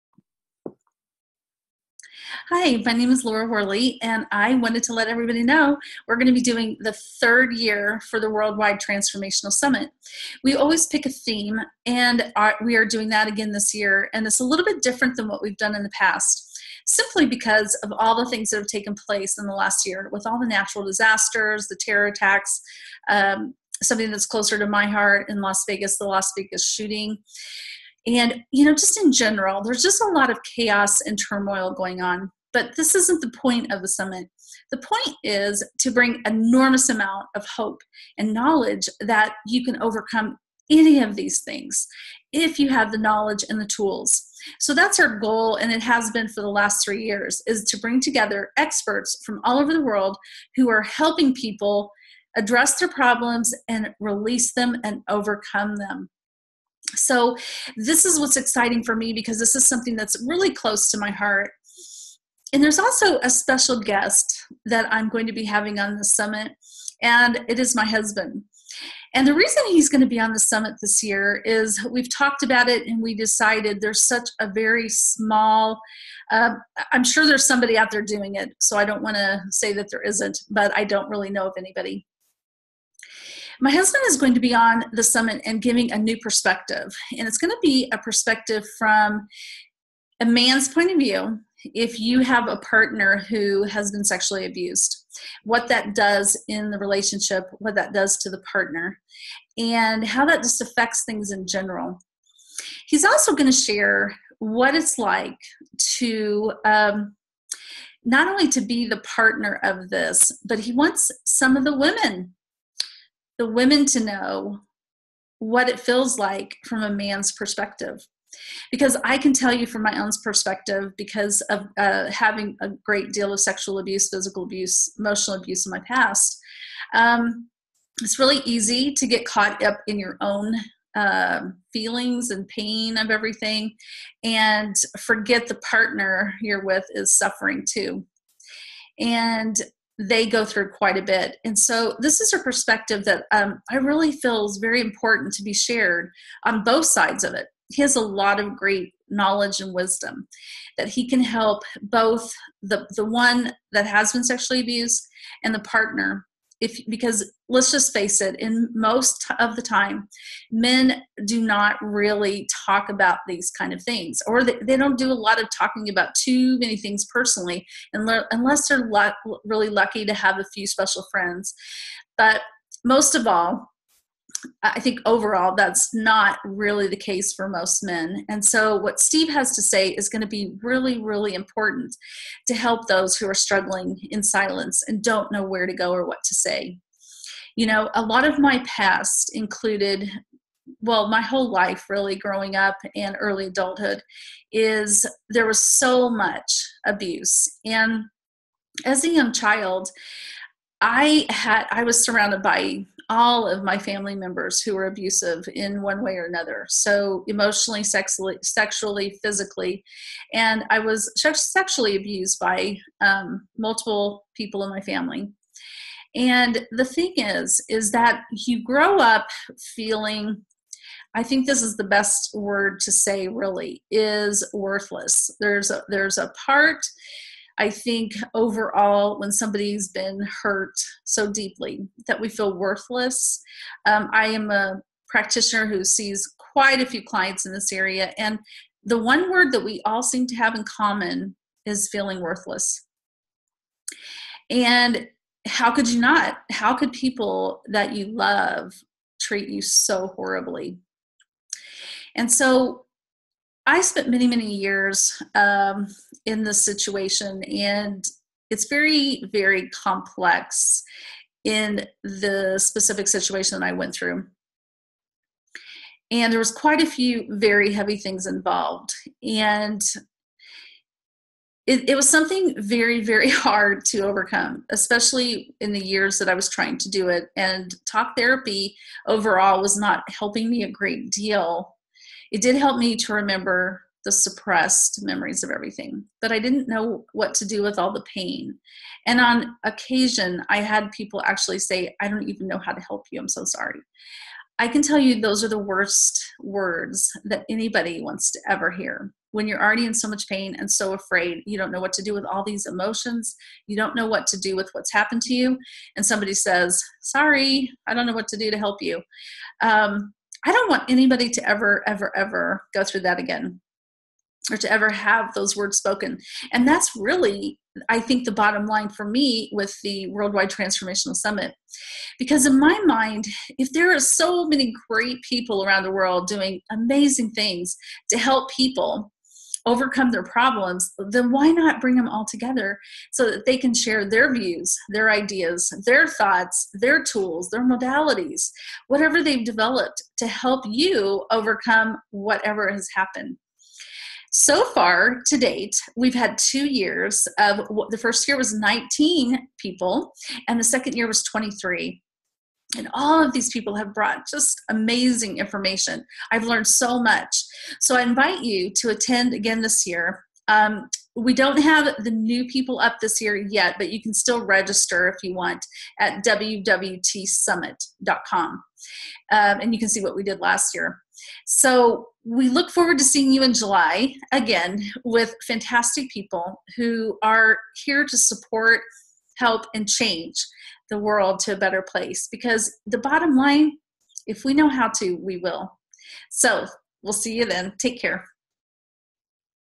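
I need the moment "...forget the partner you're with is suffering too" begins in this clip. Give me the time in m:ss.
2:14.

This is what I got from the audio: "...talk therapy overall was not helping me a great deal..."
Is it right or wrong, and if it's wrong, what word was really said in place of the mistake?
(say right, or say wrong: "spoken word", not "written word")
right.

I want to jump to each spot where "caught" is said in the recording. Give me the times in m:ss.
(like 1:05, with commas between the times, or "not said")
2:09.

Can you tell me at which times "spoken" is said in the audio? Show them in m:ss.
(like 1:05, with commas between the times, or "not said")
5:15.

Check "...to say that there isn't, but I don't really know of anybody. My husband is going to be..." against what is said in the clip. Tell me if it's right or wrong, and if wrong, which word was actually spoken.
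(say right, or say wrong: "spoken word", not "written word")
right.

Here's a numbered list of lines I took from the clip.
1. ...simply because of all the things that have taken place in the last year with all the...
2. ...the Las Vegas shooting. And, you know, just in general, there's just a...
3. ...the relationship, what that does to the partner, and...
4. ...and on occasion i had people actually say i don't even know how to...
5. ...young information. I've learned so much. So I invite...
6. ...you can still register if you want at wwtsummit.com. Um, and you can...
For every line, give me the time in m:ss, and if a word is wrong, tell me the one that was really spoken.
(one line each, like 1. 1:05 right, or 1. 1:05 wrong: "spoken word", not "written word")
1. 0:16 right
2. 0:25 right
3. 1:36 right
4. 4:49 right
5. 5:54 wrong: "amazing", not "young"
6. 6:03 right.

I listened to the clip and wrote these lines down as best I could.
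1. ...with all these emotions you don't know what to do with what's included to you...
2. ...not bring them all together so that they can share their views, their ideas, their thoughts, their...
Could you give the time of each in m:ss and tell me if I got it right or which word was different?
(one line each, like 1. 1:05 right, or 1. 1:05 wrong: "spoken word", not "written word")
1. 5:02 wrong: "happened", not "included"
2. 5:31 right.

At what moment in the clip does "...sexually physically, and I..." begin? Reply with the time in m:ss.
3:28.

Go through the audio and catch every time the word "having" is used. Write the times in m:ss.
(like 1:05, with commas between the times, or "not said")
1:05, 2:02.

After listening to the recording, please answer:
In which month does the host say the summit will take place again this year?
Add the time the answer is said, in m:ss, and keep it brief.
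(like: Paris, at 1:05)
July, at 6:13.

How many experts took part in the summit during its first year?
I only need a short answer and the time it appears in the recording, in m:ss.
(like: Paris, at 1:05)
19, at 5:48.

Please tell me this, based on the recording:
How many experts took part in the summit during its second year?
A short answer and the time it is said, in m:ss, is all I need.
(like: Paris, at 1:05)
23, at 5:51.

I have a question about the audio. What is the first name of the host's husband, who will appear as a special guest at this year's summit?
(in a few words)
Steve.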